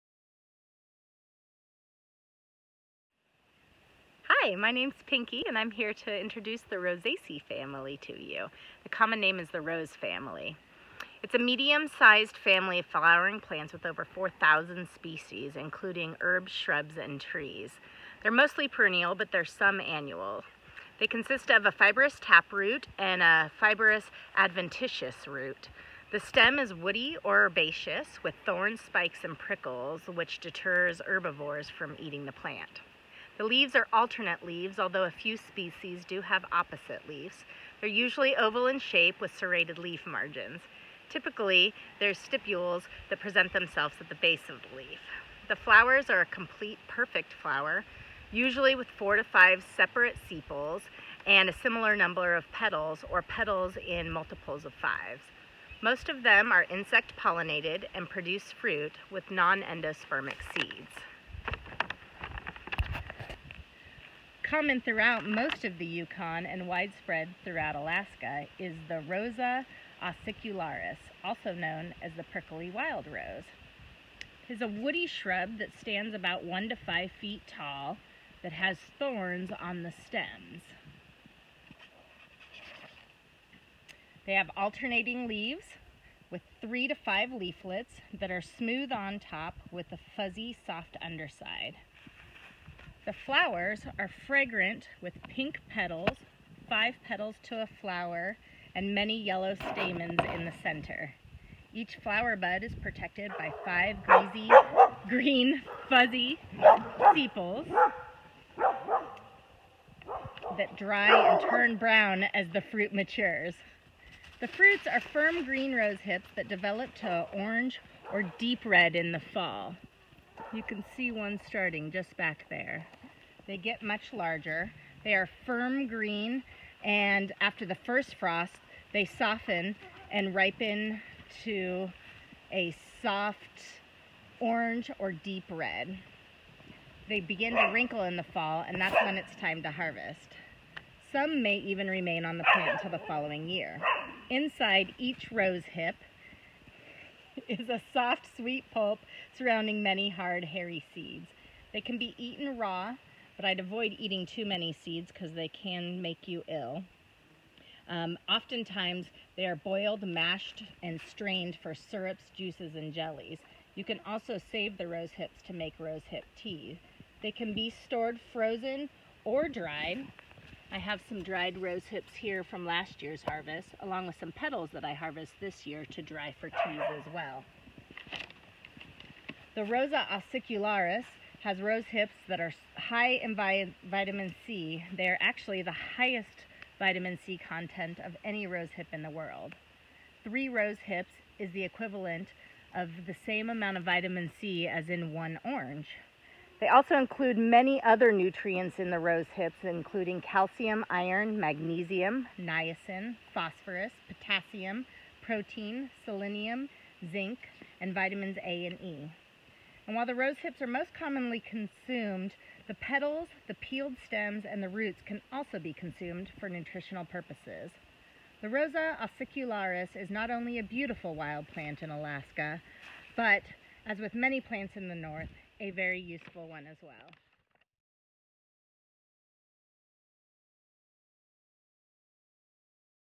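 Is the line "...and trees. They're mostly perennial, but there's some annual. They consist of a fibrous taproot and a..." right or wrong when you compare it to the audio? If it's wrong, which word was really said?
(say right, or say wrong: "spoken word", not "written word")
right.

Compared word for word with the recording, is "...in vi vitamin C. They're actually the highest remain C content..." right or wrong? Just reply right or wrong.
wrong.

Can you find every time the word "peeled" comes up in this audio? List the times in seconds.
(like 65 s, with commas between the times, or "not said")
213 s.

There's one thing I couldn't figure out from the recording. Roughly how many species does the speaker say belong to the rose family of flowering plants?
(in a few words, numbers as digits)
over 4,000.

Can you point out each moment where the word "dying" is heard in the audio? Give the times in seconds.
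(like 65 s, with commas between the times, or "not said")
not said.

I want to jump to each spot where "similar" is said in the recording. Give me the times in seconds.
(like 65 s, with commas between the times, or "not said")
51 s.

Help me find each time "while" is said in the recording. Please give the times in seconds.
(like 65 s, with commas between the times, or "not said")
209 s.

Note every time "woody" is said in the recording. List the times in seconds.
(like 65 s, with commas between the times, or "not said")
26 s, 74 s.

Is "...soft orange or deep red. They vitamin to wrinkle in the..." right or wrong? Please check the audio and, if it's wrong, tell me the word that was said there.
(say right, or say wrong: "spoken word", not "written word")
wrong: "begin", not "vitamin".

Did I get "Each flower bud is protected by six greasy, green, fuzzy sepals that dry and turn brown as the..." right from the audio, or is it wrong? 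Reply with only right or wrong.
wrong.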